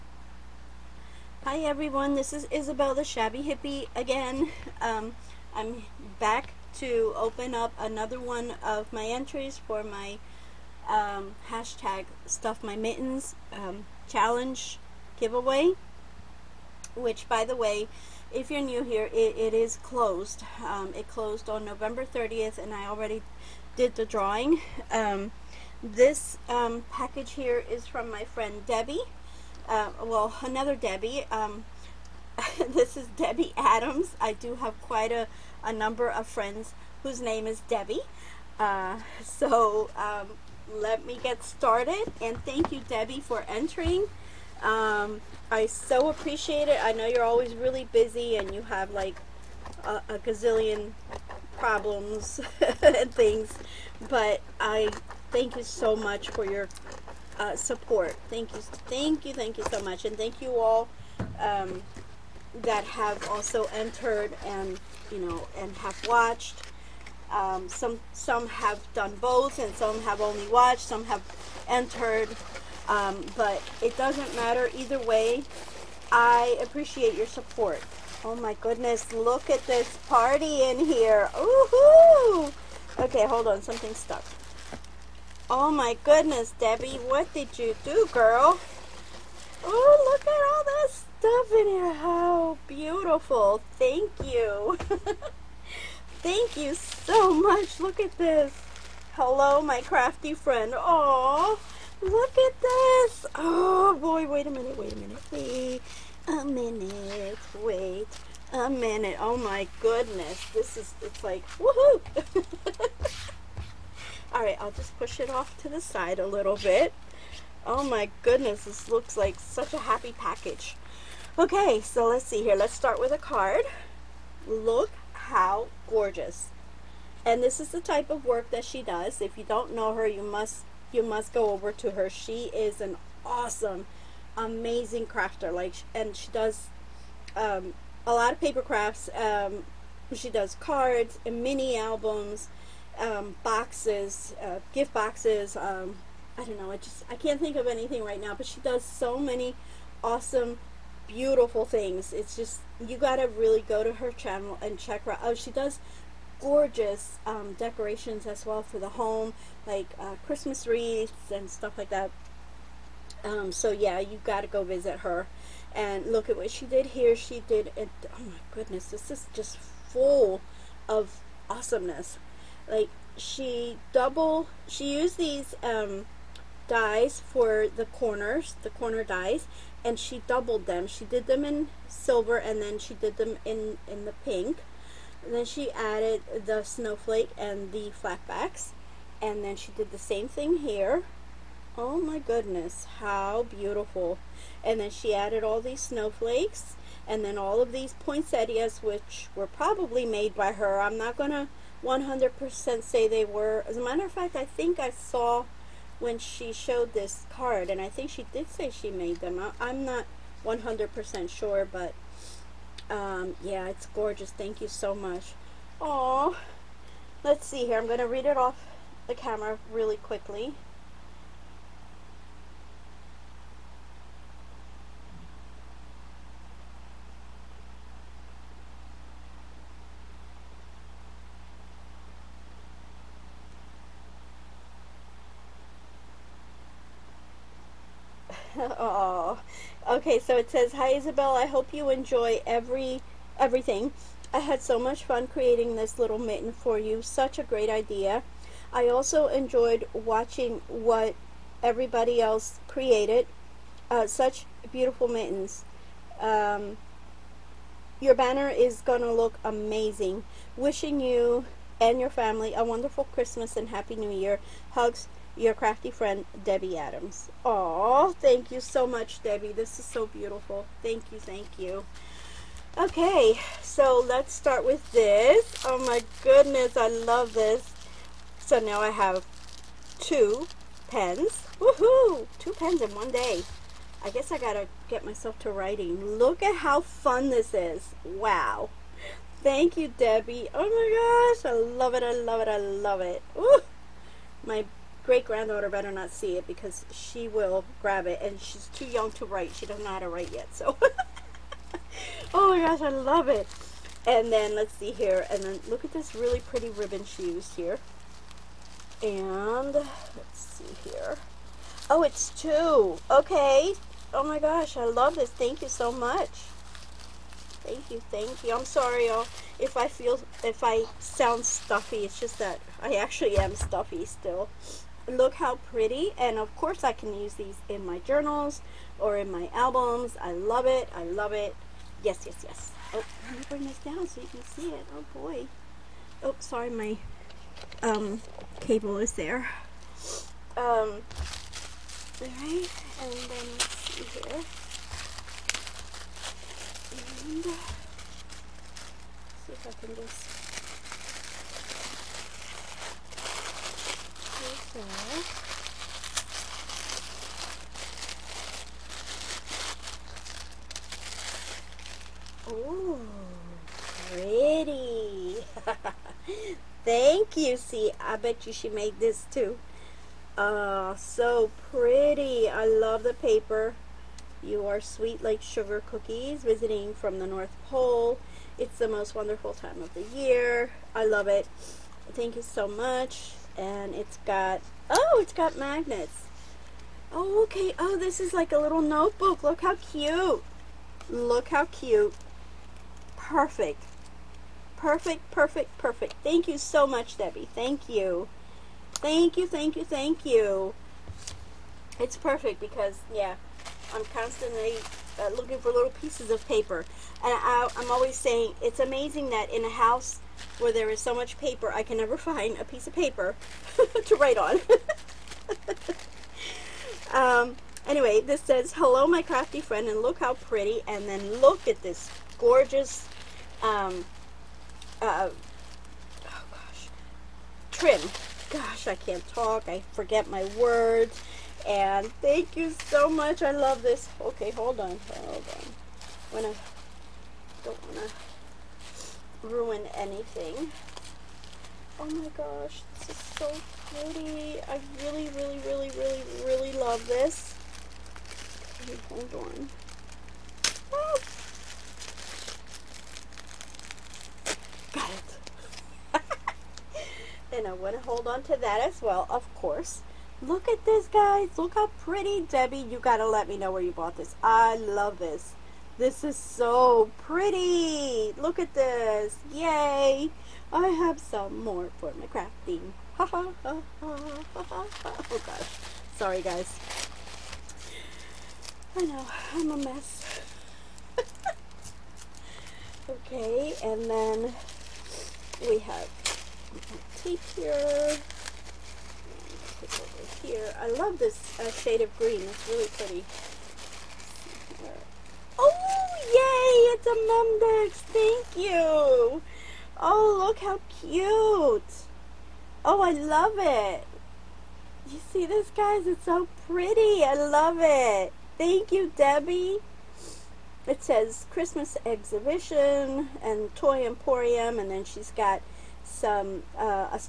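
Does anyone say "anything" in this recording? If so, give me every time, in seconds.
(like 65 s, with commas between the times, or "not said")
147 s, 439 s.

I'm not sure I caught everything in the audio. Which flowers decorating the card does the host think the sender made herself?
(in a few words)
Poinsettias.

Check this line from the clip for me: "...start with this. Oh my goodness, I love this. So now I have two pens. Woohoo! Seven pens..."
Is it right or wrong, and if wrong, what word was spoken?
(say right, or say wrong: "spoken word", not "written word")
wrong: "Two", not "Seven".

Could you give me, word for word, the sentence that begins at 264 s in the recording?
Hugs." your crafty friend Debbie Adams.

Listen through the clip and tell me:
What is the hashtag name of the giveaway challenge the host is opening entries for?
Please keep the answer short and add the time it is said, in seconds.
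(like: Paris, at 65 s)
Stuff My Mittens, at 12 s.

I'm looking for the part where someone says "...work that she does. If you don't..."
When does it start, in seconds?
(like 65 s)
128 s.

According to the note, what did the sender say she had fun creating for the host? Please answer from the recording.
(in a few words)
Mitten.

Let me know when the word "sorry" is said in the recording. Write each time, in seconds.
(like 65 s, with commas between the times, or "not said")
318 s, 336 s, 476 s.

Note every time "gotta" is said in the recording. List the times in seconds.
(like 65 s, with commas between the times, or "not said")
152 s, 284 s.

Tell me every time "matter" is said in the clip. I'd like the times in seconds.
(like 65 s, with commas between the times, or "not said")
74 s, 203 s.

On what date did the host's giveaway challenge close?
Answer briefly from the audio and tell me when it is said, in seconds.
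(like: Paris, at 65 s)
November 30th, at 21 s.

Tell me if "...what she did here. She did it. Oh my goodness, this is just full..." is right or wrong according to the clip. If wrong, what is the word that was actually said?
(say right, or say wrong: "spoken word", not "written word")
right.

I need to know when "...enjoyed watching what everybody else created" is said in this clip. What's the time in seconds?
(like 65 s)
249 s.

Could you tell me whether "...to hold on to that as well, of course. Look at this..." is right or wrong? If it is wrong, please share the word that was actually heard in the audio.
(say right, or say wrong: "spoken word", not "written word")
right.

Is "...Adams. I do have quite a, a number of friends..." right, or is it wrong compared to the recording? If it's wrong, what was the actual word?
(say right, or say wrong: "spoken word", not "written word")
right.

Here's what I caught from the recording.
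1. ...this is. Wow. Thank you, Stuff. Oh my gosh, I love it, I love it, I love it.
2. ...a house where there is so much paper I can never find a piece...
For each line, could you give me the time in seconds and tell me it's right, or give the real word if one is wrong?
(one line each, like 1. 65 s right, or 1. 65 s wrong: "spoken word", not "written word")
1. 287 s wrong: "Debbie", not "Stuff"
2. 409 s right.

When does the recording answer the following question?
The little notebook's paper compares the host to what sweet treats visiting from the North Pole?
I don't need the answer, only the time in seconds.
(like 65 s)
375 s.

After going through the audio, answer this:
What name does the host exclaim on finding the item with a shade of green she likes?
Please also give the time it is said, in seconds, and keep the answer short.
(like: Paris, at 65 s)
Mumdex, at 497 s.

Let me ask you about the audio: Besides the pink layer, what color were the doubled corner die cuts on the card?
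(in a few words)
Silver.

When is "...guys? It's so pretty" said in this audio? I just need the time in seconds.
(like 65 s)
505 s.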